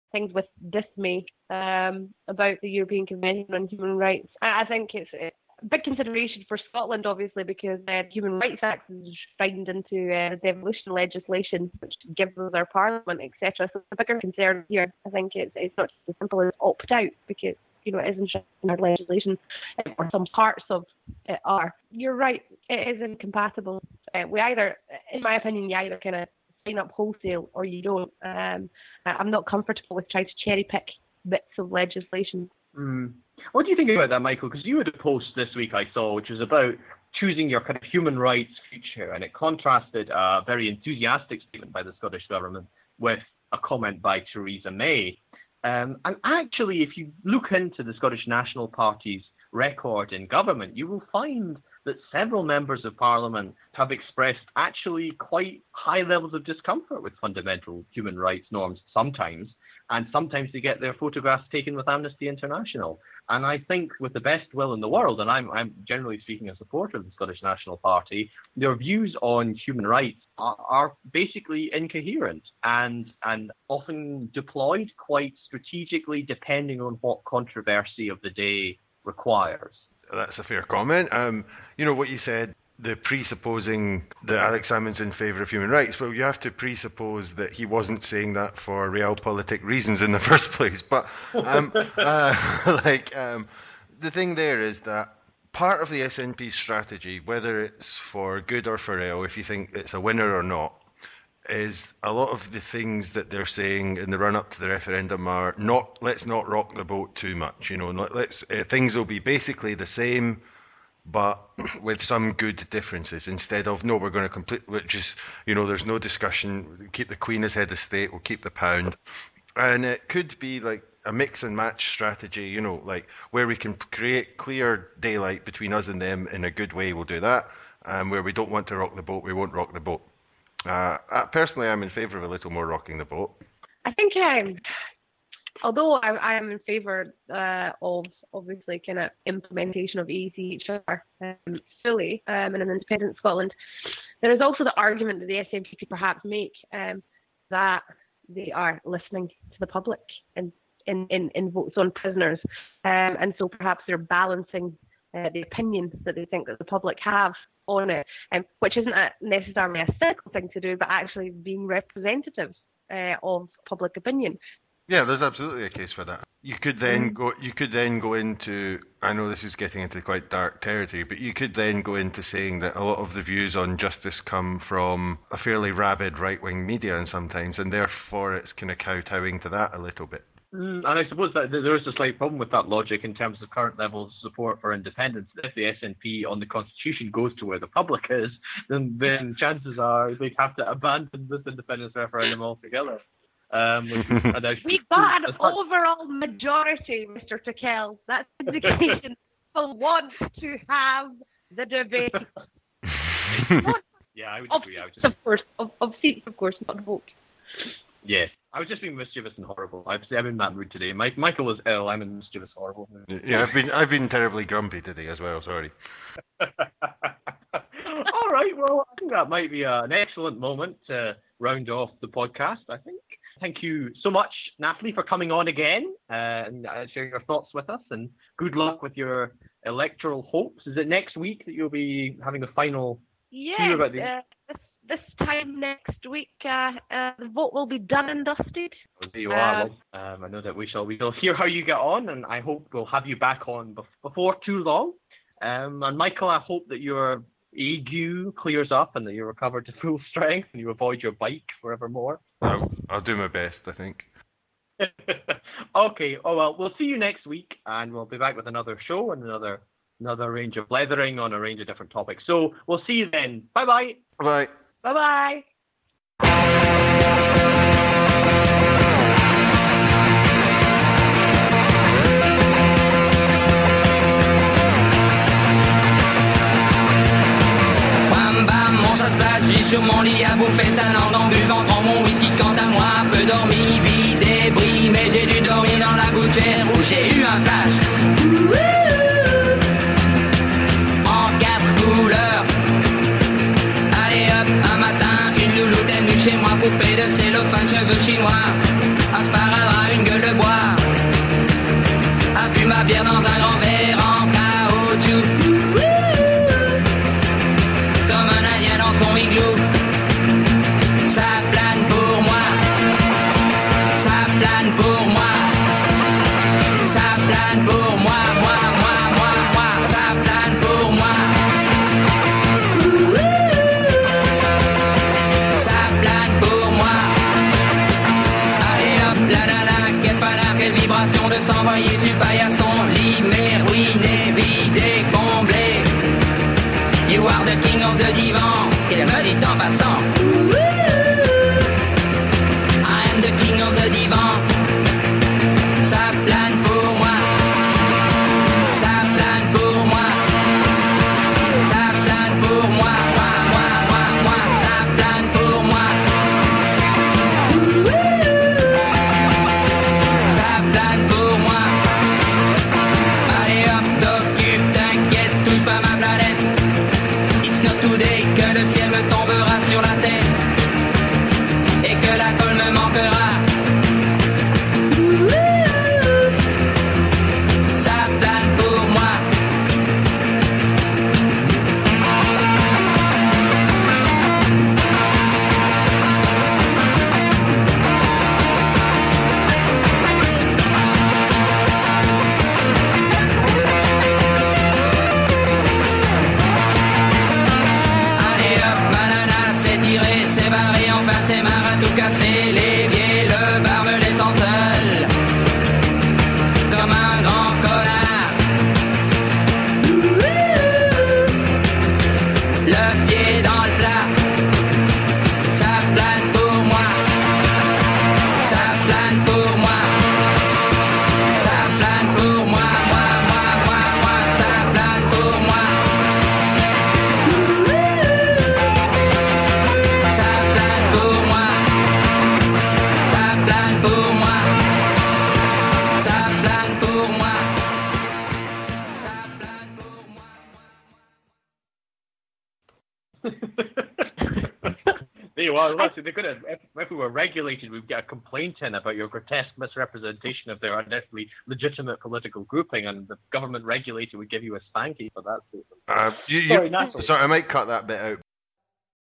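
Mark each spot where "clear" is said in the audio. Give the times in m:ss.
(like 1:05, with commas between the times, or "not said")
2:04, 4:08.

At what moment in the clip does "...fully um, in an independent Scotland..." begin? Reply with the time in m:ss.
2:21.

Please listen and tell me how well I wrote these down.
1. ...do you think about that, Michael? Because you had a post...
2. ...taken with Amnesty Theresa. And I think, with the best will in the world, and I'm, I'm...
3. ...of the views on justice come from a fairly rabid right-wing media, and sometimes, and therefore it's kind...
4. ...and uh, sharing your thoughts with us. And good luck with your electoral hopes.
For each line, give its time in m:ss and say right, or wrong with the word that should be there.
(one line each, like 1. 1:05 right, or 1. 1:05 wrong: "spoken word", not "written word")
1. 0:33 right
2. 1:01 wrong: "International", not "Theresa"
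3. 2:52 right
4. 3:46 right.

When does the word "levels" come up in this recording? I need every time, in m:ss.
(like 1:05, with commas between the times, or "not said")
0:56, 3:03.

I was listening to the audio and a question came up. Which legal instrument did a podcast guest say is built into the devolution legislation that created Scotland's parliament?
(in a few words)
Human Rights Act.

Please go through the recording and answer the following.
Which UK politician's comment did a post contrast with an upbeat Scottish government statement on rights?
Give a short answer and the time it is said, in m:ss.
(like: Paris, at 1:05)
Theresa May, at 0:44.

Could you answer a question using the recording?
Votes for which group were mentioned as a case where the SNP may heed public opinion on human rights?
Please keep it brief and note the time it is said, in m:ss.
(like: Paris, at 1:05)
prisoners, at 2:31.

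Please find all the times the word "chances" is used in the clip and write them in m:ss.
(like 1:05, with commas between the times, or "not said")
3:09.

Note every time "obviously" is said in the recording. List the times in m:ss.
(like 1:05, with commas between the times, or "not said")
0:07, 2:18.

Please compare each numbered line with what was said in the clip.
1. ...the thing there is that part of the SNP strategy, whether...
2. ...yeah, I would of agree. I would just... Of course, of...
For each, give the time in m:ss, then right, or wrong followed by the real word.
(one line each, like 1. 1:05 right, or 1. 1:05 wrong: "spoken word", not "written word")
1. 1:33 right
2. 3:24 right.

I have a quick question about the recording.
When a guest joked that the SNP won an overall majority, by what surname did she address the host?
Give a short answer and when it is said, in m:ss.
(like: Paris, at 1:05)
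Tickell, at 3:17.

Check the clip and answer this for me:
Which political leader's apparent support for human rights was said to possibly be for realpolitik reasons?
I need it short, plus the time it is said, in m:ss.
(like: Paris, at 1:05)
Alex Salmond, at 1:24.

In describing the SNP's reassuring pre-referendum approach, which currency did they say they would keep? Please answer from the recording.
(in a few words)
the pound.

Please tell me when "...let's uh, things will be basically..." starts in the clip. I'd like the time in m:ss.
1:47.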